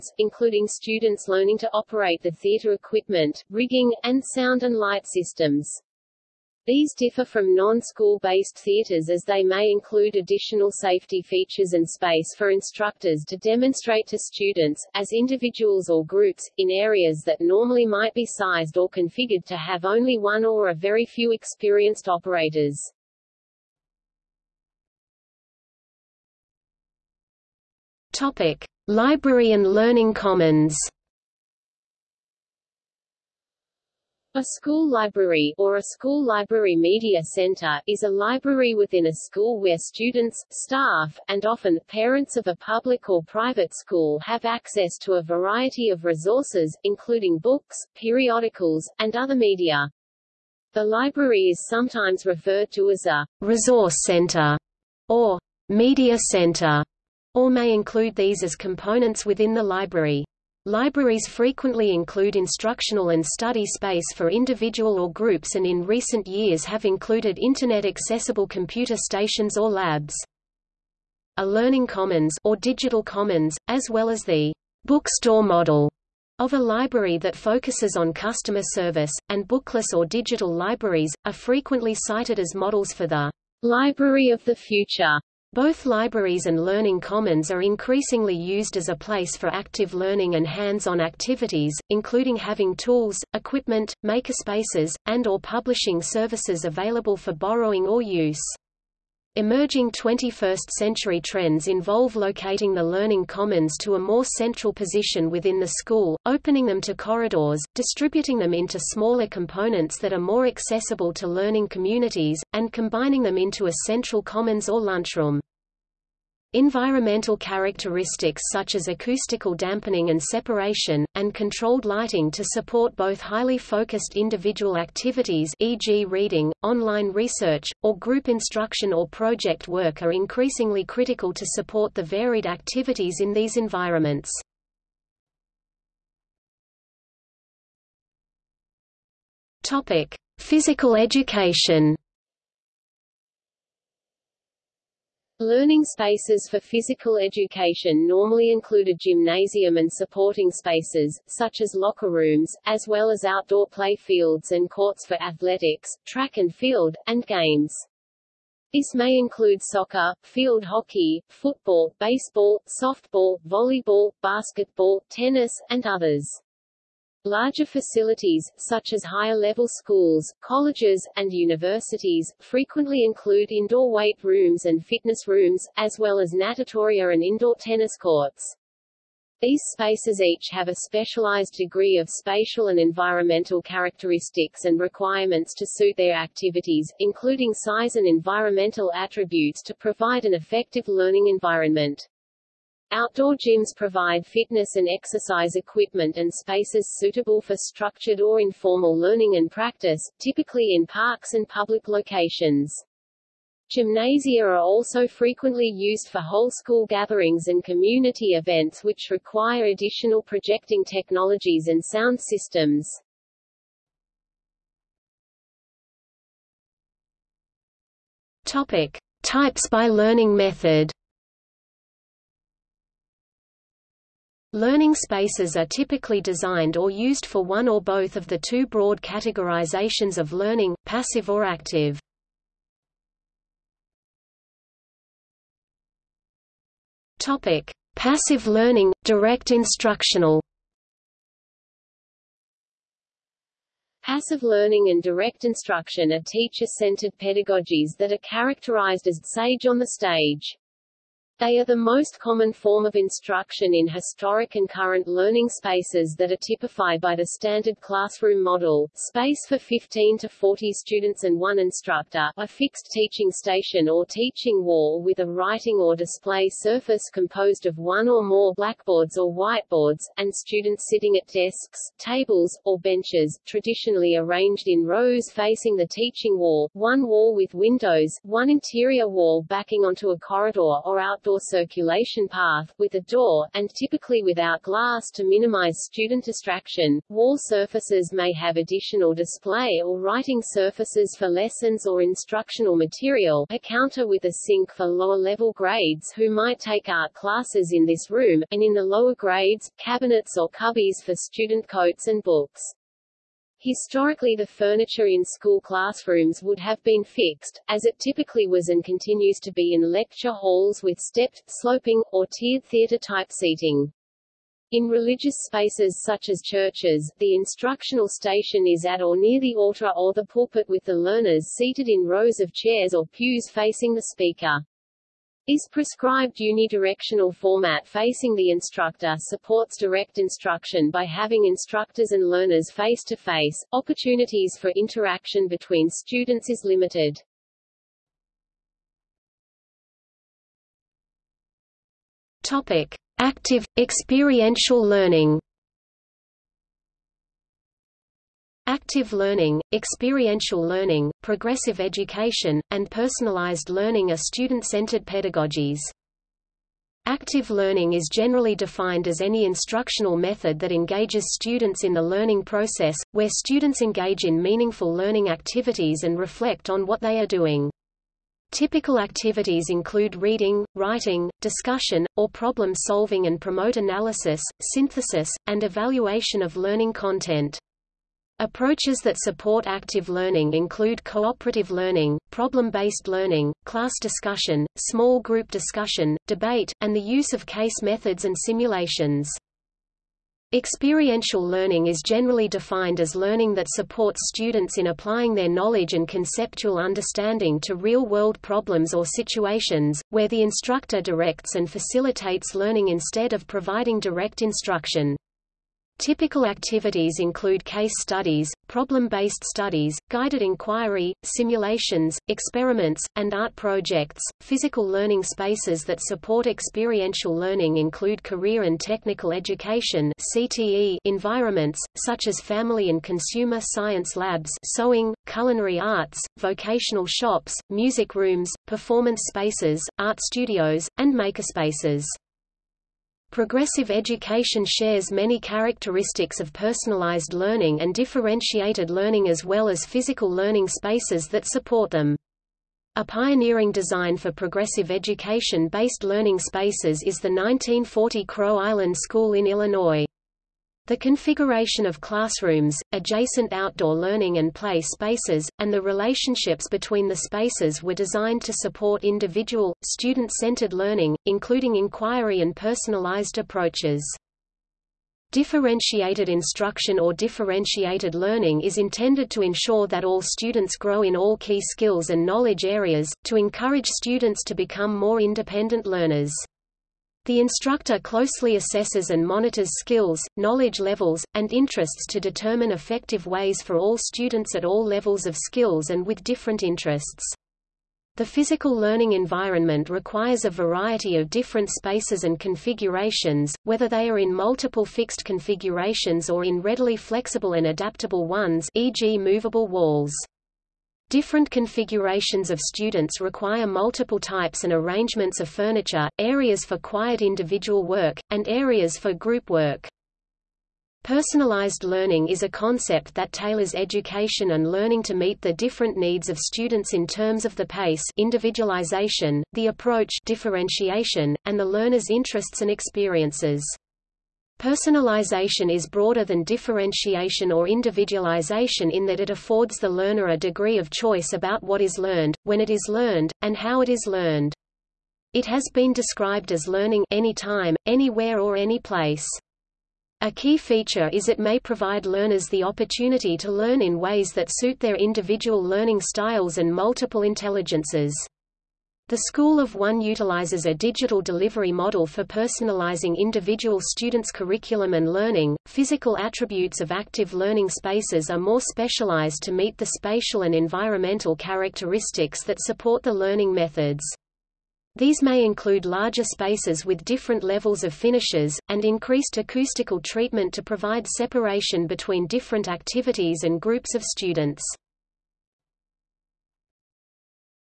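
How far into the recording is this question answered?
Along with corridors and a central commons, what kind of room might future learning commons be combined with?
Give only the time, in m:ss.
1:54.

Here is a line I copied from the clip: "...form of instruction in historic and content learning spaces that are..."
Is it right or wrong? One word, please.
wrong.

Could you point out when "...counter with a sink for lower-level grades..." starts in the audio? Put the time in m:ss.
4:53.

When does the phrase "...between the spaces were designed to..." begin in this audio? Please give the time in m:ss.
7:36.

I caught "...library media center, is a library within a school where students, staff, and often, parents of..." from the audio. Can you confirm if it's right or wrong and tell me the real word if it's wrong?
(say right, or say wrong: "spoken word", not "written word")
right.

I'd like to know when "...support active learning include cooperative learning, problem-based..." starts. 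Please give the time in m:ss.
6:19.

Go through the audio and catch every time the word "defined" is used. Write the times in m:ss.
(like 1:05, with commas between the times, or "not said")
5:58, 6:32.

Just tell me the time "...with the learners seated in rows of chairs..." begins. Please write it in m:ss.
5:20.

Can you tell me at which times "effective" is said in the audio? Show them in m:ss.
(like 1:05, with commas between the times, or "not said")
3:10, 8:02.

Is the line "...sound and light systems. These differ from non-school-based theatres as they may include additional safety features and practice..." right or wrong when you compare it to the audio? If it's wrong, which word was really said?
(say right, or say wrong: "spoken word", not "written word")
wrong: "space", not "practice".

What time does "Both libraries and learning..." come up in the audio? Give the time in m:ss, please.
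1:25.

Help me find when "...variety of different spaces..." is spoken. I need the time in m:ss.
8:10.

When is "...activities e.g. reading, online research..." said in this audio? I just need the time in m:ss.
2:04.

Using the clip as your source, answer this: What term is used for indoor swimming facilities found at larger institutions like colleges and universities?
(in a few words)
natatoria.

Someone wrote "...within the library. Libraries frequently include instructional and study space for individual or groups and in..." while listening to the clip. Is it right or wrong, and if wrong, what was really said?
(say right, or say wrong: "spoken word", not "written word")
right.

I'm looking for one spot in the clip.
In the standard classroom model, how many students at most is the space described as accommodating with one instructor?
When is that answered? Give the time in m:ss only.
4:20.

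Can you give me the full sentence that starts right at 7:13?
Progressive education shares many characteristics of personalized learning and differentiated learning as well as physical learning spaces that support them.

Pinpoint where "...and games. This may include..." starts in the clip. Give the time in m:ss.
2:37.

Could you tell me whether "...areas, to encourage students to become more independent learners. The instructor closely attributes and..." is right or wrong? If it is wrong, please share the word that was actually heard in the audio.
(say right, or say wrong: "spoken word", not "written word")
wrong: "assesses", not "attributes".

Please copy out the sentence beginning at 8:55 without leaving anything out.
It has been described as learning anytime, anywhere or any place.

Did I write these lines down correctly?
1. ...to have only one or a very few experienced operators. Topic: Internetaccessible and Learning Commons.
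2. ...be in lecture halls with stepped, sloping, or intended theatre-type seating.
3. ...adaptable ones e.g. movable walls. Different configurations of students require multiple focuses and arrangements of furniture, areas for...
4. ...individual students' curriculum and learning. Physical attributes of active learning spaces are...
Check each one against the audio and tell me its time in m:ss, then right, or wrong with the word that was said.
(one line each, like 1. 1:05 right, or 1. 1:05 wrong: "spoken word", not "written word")
1. 0:19 wrong: "Library", not "Internetaccessible"
2. 5:09 wrong: "tiered", not "intended"
3. 8:17 wrong: "types", not "focuses"
4. 9:13 right.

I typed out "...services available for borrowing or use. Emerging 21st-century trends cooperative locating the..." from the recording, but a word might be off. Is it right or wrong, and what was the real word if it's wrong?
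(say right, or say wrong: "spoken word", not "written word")
wrong: "involve", not "cooperative".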